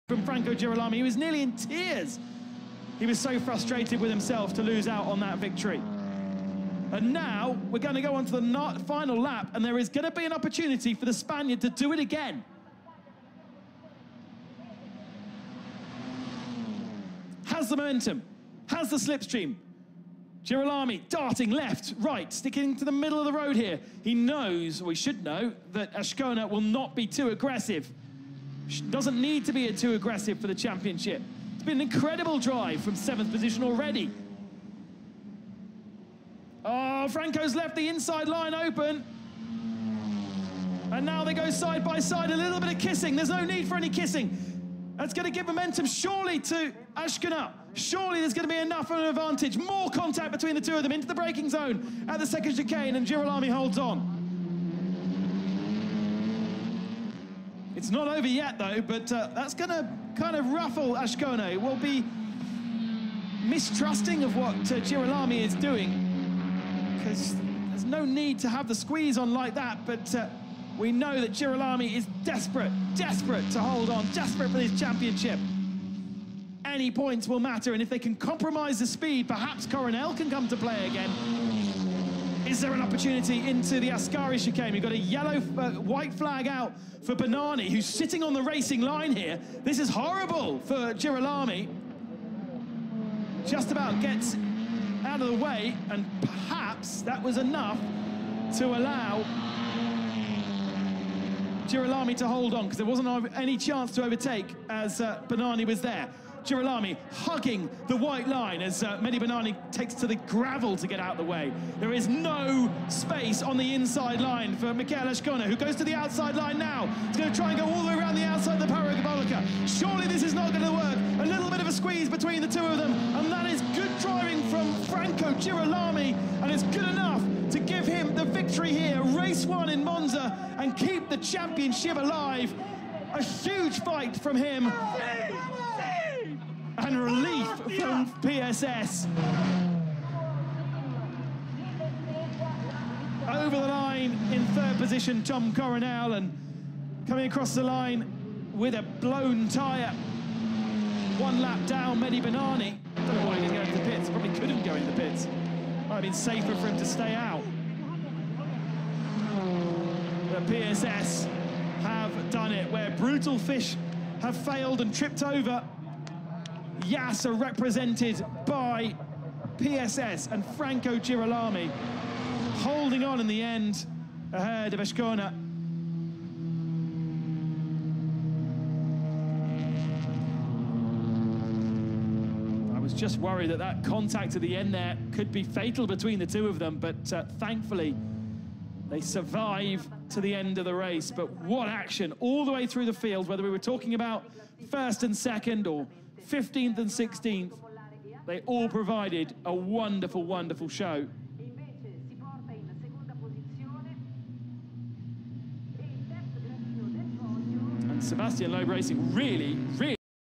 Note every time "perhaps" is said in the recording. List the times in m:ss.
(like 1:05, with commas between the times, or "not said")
1:19, 1:36.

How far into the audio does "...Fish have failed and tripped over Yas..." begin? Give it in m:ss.
2:43.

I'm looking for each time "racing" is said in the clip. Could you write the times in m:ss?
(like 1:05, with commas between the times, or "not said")
1:28, 3:28.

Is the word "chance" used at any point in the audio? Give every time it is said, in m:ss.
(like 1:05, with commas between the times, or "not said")
1:43.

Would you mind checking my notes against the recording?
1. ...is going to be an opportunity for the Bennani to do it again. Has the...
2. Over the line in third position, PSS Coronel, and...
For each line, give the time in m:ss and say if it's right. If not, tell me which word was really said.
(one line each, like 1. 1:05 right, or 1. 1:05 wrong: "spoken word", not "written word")
1. 0:09 wrong: "Spaniard", not "Bennani"
2. 2:23 wrong: "Tom", not "PSS".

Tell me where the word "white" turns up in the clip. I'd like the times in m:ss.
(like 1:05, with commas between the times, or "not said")
1:25, 1:47.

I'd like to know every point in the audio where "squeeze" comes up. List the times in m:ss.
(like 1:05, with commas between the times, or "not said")
1:08, 2:01.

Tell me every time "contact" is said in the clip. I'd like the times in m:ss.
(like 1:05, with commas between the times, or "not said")
0:49, 3:03.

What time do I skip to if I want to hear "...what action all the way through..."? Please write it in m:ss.
3:11.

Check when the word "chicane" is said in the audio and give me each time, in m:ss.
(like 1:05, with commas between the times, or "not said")
0:52, 1:24.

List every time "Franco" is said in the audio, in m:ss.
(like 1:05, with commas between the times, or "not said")
0:00, 0:37, 2:04, 2:50.